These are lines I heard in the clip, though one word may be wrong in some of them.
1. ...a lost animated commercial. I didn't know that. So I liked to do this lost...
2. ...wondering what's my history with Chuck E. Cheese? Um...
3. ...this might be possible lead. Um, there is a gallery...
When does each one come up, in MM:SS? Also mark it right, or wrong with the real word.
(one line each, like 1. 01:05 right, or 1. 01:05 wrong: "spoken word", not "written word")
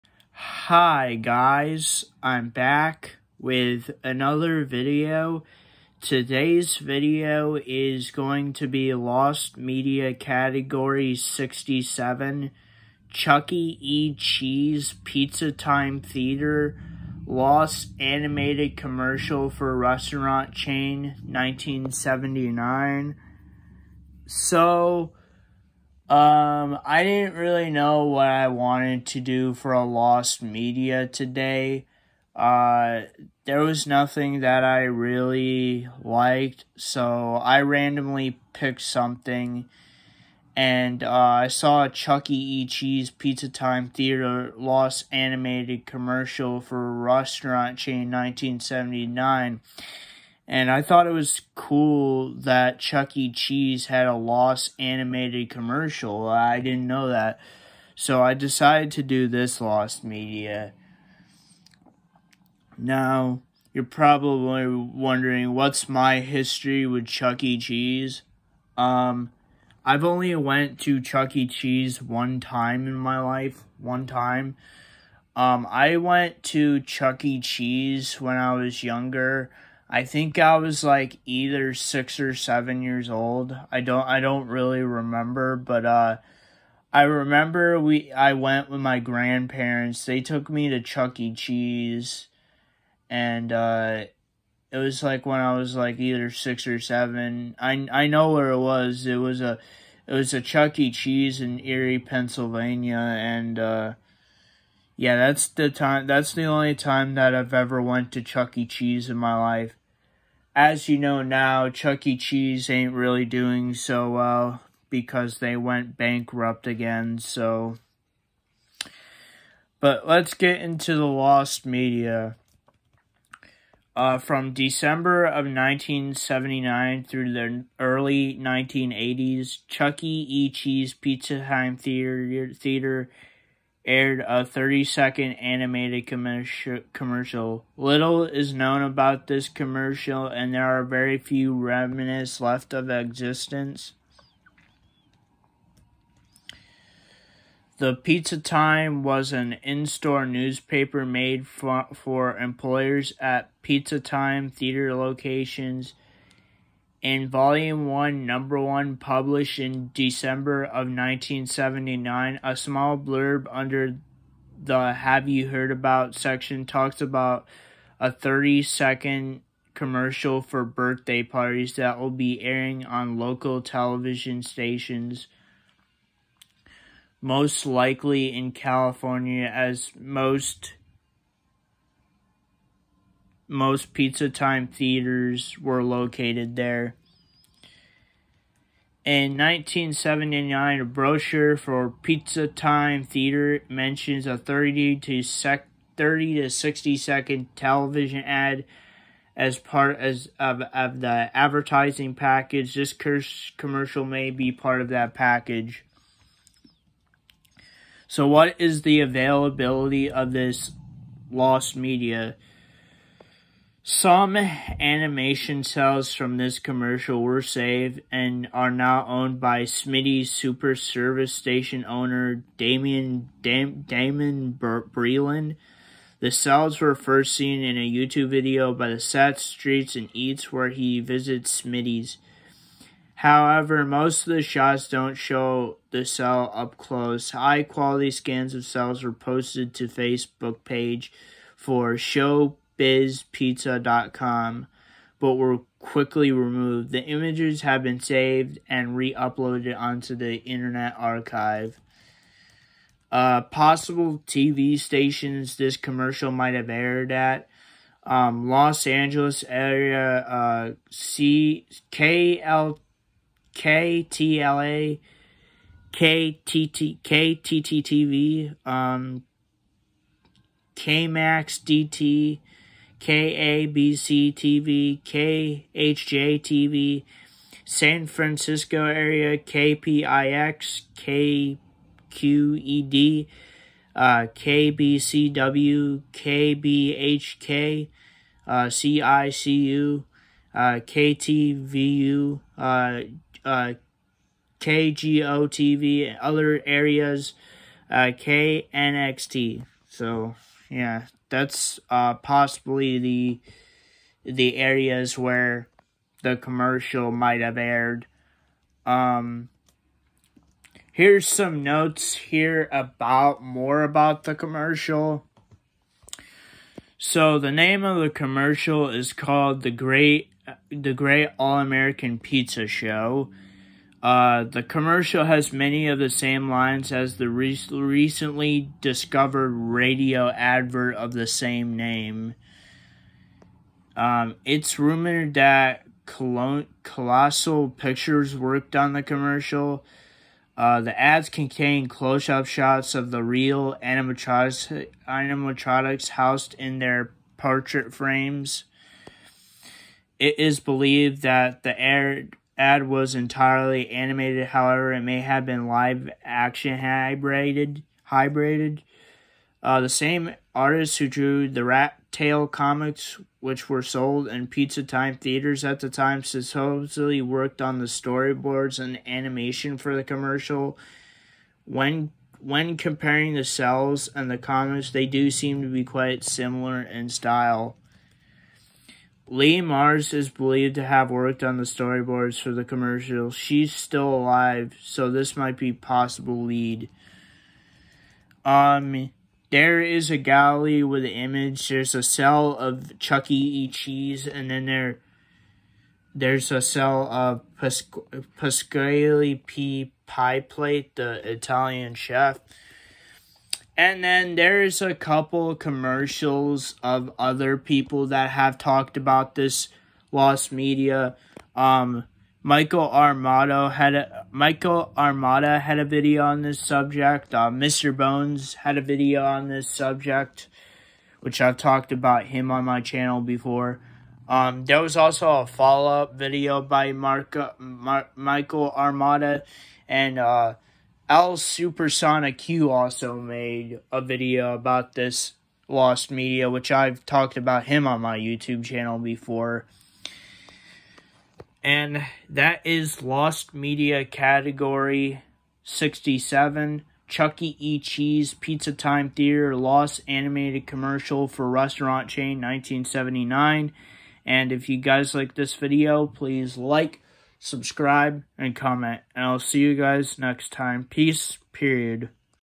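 1. 00:54 wrong: "decided", not "liked"
2. 01:04 right
3. 06:25 right.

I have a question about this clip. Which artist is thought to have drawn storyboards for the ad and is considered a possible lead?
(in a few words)
Lee Marrs.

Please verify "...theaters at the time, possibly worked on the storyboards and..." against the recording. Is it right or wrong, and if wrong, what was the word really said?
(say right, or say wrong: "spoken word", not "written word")
wrong: "supposedly", not "possibly".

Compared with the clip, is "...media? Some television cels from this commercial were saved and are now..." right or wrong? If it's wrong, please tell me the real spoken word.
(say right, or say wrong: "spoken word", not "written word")
wrong: "animation", not "television".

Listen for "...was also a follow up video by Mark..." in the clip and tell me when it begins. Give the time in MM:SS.
07:04.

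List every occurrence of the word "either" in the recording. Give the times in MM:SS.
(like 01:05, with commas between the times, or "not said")
01:21, 01:35.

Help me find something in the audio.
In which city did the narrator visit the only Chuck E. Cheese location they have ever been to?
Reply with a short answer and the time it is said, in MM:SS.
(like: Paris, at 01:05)
Erie, Pennsylvania, at 01:41.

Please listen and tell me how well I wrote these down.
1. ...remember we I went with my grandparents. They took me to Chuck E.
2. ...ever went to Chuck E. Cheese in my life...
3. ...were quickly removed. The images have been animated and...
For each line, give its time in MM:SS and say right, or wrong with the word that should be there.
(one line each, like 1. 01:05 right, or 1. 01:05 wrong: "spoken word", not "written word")
1. 01:27 right
2. 01:47 right
3. 04:05 wrong: "saved", not "animated".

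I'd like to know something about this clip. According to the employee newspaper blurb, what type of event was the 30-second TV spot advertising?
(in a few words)
Birthday parties.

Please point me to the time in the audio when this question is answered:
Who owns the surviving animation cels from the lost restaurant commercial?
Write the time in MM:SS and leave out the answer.
03:43.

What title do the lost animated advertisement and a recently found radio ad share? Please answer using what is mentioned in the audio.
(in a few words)
The Great All American Pizza Show.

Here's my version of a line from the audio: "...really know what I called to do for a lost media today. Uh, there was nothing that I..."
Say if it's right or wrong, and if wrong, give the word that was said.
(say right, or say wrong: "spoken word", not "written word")
wrong: "wanted", not "called".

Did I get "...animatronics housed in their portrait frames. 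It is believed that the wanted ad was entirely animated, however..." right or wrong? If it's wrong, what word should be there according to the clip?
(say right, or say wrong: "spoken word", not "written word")
wrong: "aired", not "wanted".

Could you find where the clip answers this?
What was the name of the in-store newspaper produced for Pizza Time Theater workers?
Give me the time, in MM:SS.
02:27.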